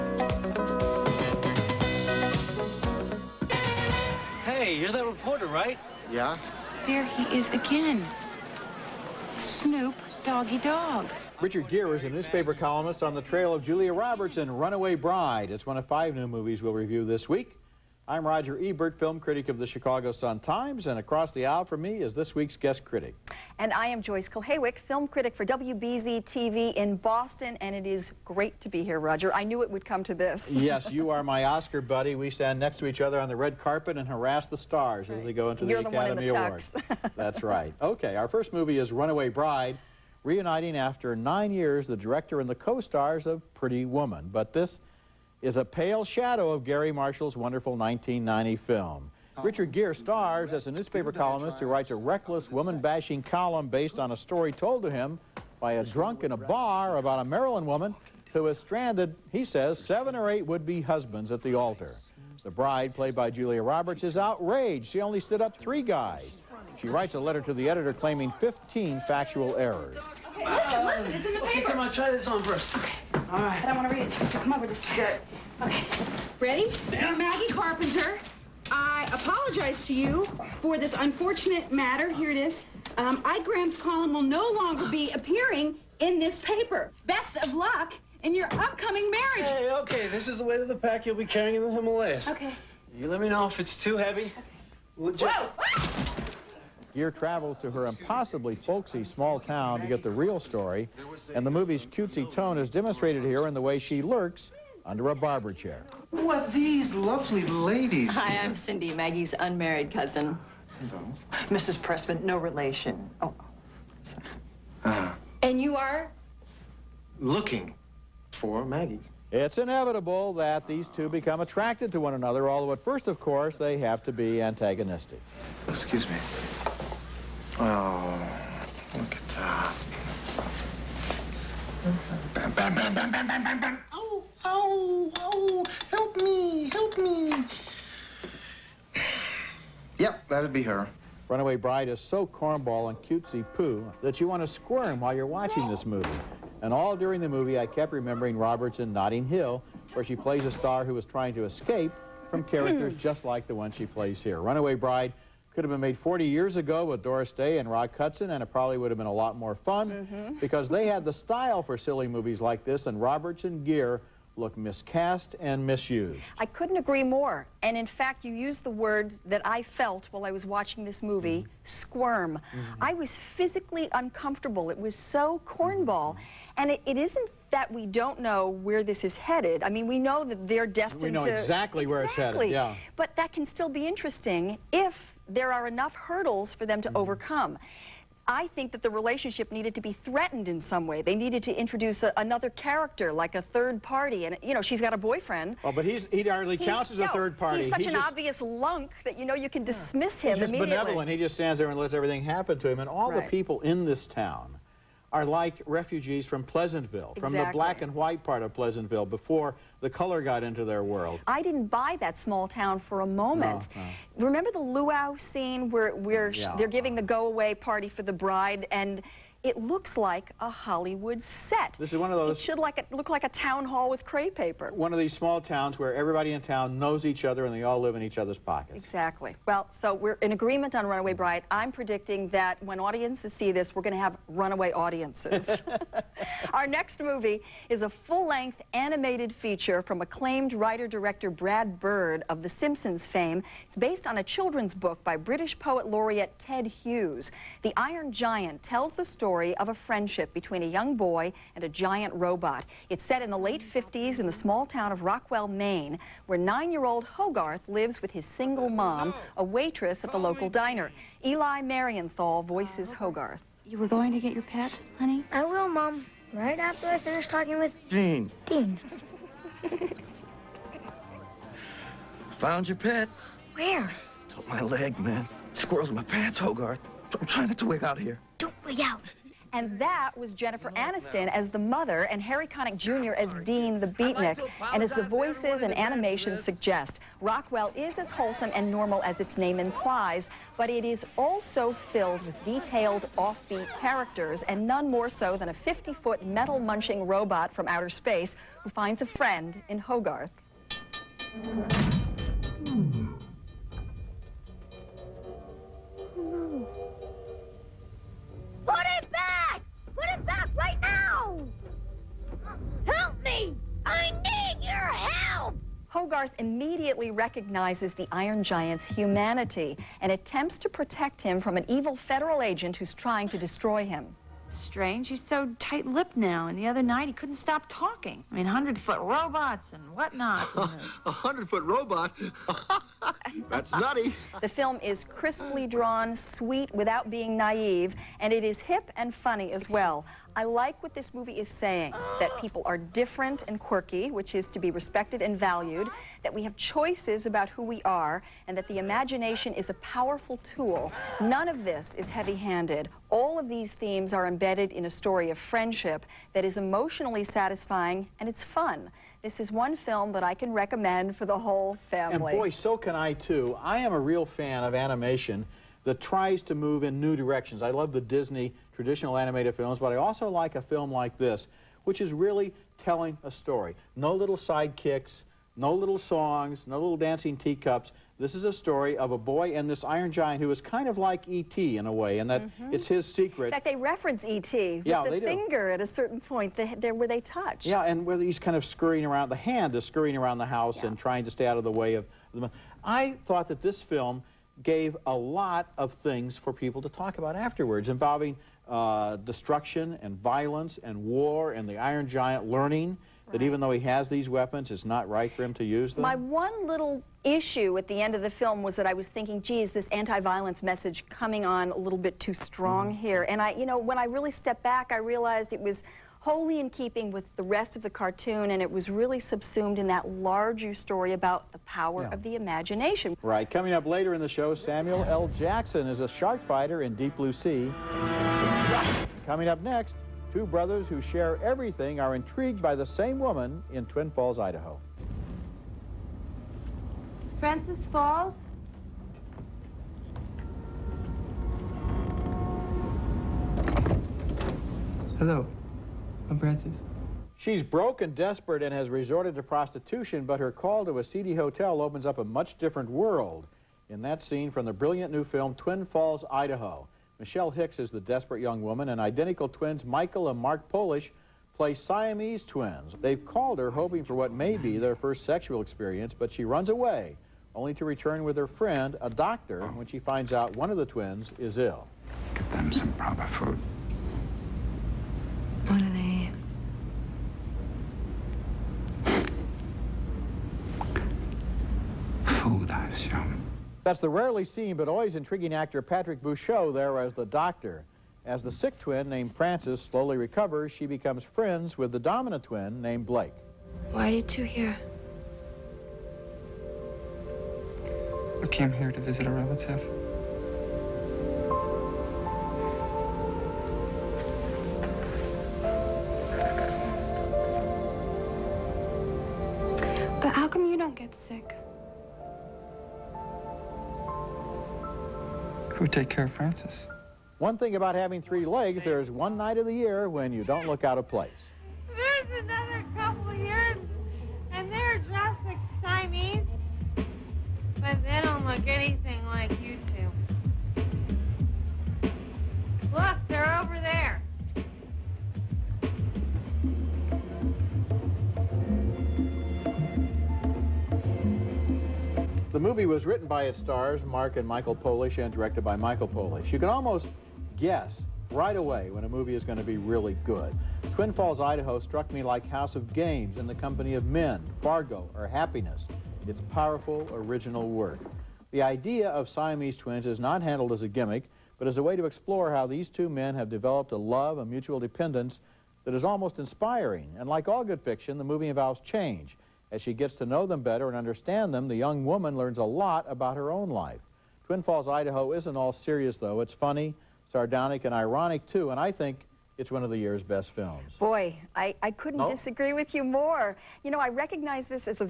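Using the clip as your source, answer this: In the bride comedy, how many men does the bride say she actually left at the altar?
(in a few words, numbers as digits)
3.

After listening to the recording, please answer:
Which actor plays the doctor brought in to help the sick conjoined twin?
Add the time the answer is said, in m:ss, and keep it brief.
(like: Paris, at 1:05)
Patrick Bauchau, at 8:05.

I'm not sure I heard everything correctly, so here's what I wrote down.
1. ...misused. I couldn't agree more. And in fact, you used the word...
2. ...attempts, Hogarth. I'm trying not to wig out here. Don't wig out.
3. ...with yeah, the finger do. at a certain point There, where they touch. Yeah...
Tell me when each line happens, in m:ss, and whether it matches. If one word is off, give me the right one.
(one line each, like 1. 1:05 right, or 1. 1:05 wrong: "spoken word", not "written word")
1. 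2:45 right
2. 4:36 wrong: "pants", not "attempts"
3. 6:24 right.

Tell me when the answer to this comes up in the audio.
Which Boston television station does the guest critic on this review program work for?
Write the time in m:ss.
0:25.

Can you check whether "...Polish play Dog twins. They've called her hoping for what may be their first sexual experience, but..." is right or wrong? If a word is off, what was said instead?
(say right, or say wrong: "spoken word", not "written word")
wrong: "Siamese", not "Dog".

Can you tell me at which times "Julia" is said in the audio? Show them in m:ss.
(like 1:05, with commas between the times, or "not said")
0:13, 1:03.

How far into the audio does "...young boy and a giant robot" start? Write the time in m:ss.
4:10.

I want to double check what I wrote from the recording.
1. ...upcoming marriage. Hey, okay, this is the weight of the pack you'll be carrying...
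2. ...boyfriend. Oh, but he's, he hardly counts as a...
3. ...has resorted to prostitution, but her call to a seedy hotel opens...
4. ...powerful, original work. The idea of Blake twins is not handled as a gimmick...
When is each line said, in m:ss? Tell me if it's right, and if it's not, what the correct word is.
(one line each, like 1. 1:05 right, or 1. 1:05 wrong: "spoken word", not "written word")
1. 1:28 right
2. 3:15 right
3. 7:28 right
4. 9:16 wrong: "Siamese", not "Blake".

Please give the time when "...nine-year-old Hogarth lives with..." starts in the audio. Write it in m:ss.
4:16.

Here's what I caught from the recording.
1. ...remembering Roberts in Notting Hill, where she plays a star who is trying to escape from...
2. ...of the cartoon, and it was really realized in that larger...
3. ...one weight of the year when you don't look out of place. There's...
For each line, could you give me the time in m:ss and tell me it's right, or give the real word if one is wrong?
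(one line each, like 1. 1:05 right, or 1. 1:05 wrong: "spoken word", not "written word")
1. 2:27 right
2. 6:57 wrong: "subsumed", not "realized"
3. 8:39 wrong: "night", not "weight".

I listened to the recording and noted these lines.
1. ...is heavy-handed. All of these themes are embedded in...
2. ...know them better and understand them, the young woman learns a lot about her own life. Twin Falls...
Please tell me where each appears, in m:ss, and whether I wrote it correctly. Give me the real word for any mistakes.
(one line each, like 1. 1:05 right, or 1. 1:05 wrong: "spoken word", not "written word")
1. 5:51 right
2. 9:30 right.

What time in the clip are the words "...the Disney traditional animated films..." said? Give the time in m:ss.
6:07.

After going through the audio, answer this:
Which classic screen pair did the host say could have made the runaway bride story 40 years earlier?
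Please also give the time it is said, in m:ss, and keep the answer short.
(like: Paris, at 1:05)
Doris Day and Rock Hudson, at 2:37.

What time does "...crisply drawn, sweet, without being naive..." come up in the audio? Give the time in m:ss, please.
5:35.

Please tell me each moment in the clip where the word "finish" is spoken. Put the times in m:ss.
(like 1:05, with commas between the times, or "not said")
4:26.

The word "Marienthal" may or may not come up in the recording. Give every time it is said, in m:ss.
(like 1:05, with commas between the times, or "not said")
4:21.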